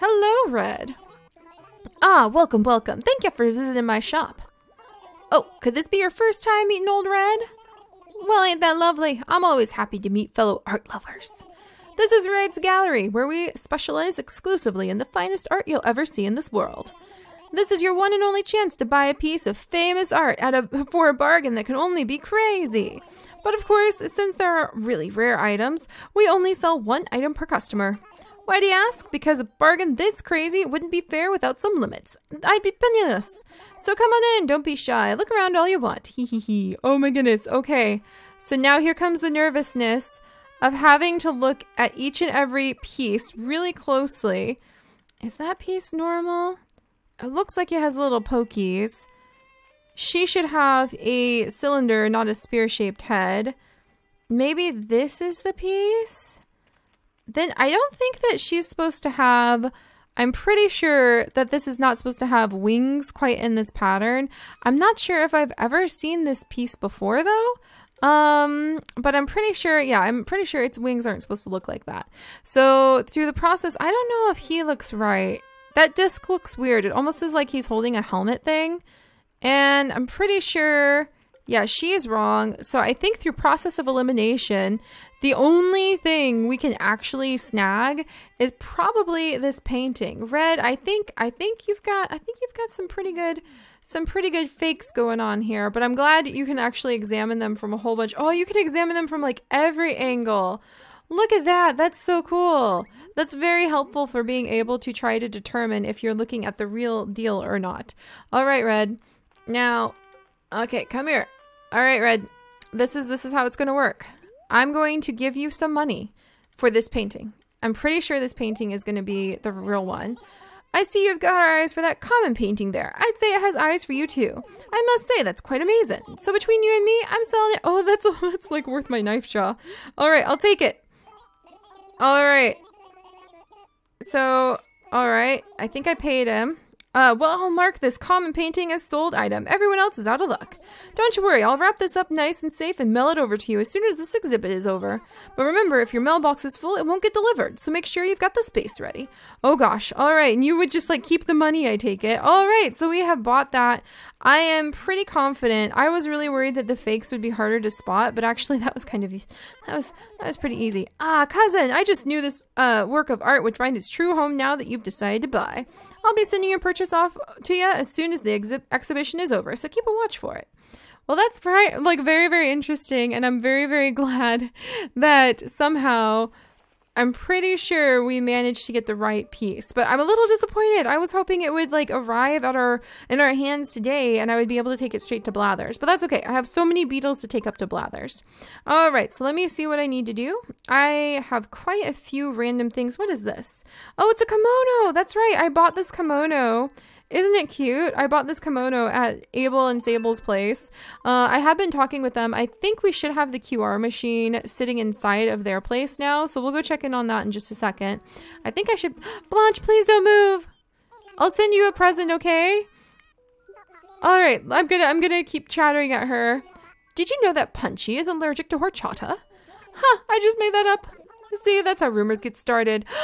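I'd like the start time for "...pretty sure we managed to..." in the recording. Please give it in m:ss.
2:57.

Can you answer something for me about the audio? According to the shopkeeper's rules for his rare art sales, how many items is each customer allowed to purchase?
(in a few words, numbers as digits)
1.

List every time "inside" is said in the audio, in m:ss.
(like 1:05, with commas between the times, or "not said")
3:24.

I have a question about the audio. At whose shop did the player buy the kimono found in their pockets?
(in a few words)
Abel and Sable's.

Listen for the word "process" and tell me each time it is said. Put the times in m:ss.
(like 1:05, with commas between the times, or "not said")
1:13, 1:23.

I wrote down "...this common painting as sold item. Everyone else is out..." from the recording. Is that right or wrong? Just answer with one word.
right.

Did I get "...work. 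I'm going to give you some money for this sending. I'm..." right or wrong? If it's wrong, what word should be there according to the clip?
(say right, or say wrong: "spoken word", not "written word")
wrong: "painting", not "sending".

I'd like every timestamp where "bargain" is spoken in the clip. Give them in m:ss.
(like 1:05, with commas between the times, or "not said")
0:21, 0:29.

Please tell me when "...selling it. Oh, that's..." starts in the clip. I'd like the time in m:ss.
2:07.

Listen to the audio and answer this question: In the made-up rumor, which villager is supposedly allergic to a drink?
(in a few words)
Punchy.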